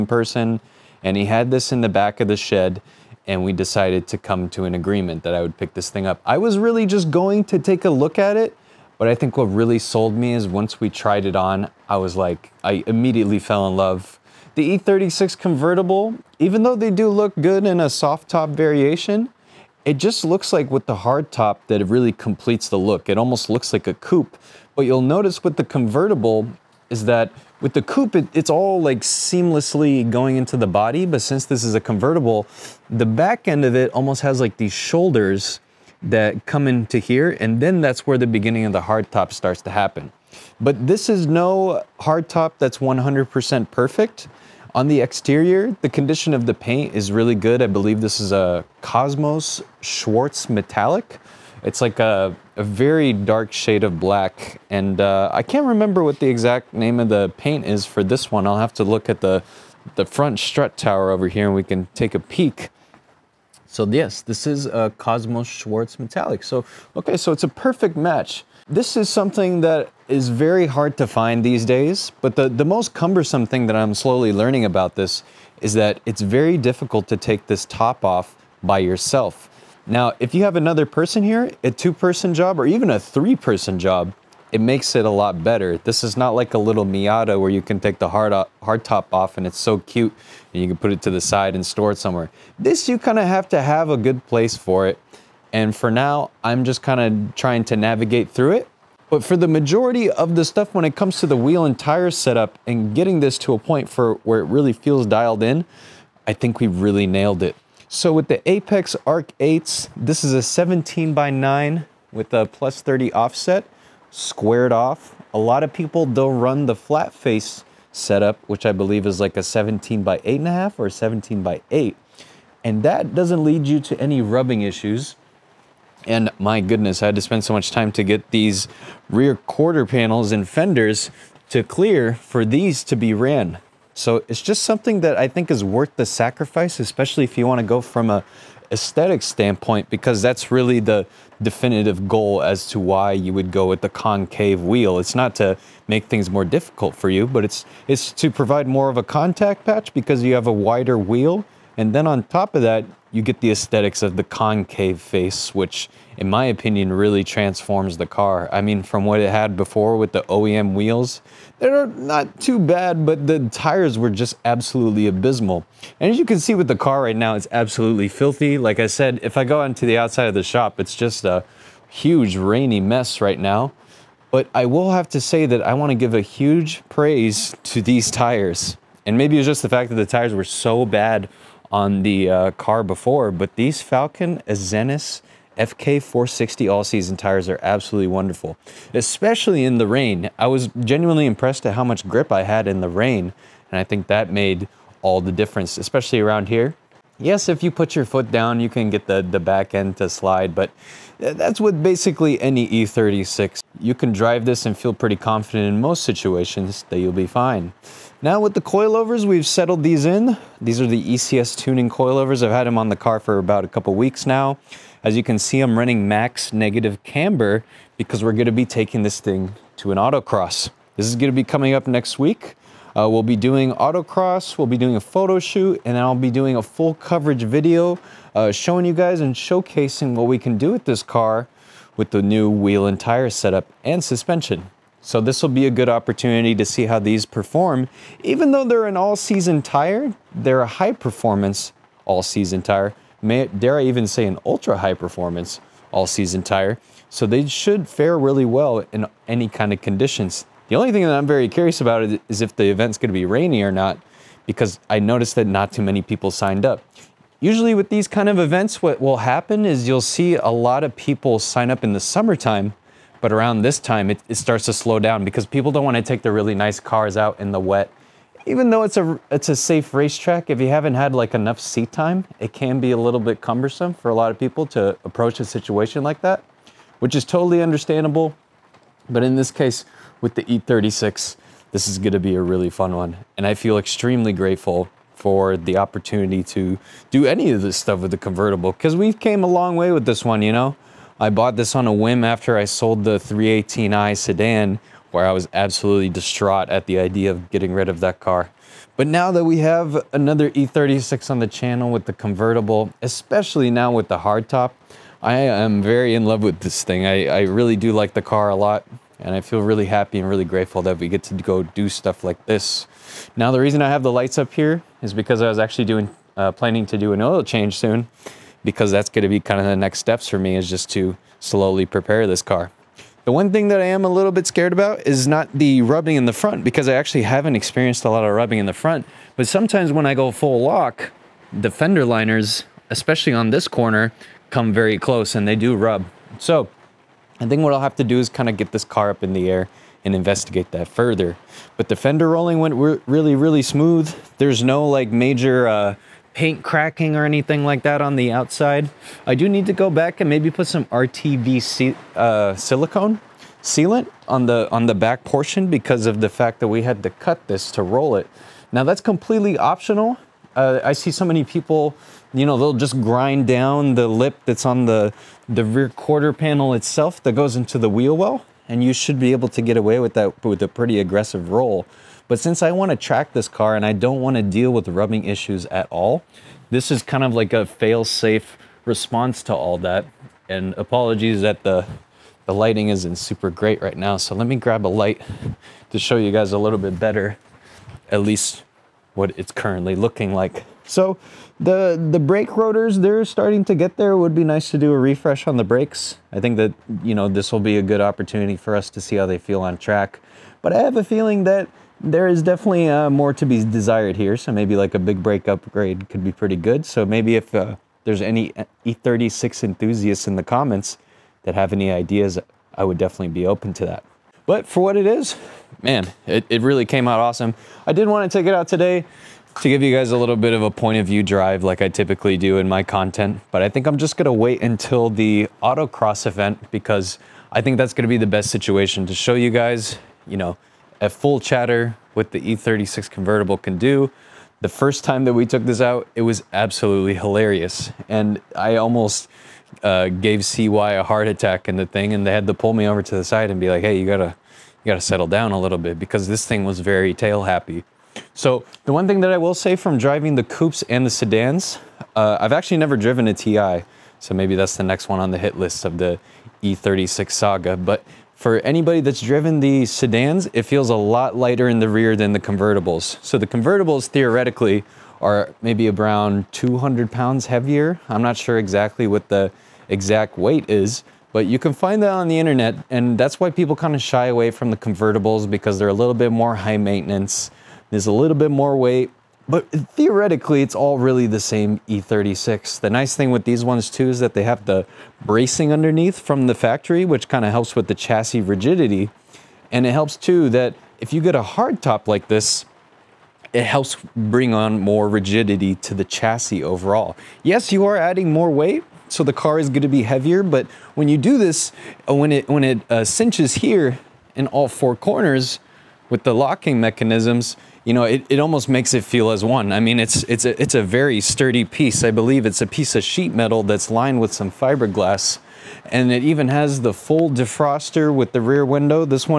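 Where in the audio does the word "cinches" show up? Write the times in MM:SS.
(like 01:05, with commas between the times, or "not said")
08:23.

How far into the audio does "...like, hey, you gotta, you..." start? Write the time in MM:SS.
07:23.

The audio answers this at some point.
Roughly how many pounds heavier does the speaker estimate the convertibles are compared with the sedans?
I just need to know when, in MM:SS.
07:46.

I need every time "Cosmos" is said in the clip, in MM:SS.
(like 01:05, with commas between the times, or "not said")
00:48, 01:04.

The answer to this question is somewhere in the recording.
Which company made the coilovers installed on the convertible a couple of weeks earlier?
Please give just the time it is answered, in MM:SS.
03:31.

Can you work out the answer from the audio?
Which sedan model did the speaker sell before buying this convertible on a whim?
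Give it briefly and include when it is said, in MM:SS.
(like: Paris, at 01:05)
318i, at 04:53.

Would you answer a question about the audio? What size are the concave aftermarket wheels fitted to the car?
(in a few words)
17 by 9.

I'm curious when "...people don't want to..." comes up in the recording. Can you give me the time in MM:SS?
04:25.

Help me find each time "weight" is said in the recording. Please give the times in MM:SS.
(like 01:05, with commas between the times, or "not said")
07:50, 07:58, 08:18.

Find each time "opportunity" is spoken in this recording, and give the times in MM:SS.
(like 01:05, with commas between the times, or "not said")
03:55, 04:45, 06:37.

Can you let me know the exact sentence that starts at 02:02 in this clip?
And that doesn't lead you to any rubbing issues.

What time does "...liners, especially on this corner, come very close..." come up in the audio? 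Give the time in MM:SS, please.
05:32.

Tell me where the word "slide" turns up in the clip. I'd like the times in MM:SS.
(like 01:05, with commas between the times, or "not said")
03:20.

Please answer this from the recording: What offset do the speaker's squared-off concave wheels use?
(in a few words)
plus 30.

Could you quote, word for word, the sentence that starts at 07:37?
But for anybody that's driven the sedans, it feels a lot lighter in the rear than the convertibles.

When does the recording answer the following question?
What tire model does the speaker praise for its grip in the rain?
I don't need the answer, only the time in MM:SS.
03:03.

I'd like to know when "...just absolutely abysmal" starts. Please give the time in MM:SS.
02:44.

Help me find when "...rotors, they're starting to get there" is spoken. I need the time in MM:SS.
06:32.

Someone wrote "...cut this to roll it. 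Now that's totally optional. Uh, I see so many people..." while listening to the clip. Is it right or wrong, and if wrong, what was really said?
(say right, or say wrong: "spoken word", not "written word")
wrong: "completely", not "totally".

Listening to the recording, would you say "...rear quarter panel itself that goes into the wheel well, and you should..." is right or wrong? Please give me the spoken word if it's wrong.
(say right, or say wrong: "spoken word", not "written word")
right.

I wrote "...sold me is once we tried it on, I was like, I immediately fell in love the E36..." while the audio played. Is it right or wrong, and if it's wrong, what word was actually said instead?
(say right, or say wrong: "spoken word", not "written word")
right.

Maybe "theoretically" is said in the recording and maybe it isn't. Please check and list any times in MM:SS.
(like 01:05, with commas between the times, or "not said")
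07:44, 07:59.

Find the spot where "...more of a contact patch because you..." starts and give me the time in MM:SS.
02:28.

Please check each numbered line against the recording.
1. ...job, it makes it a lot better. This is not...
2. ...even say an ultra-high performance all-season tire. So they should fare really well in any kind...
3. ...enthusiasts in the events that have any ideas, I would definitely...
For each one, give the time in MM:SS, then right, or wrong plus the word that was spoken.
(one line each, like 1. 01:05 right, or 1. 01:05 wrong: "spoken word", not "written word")
1. 01:23 right
2. 04:03 right
3. 06:49 wrong: "comments", not "events".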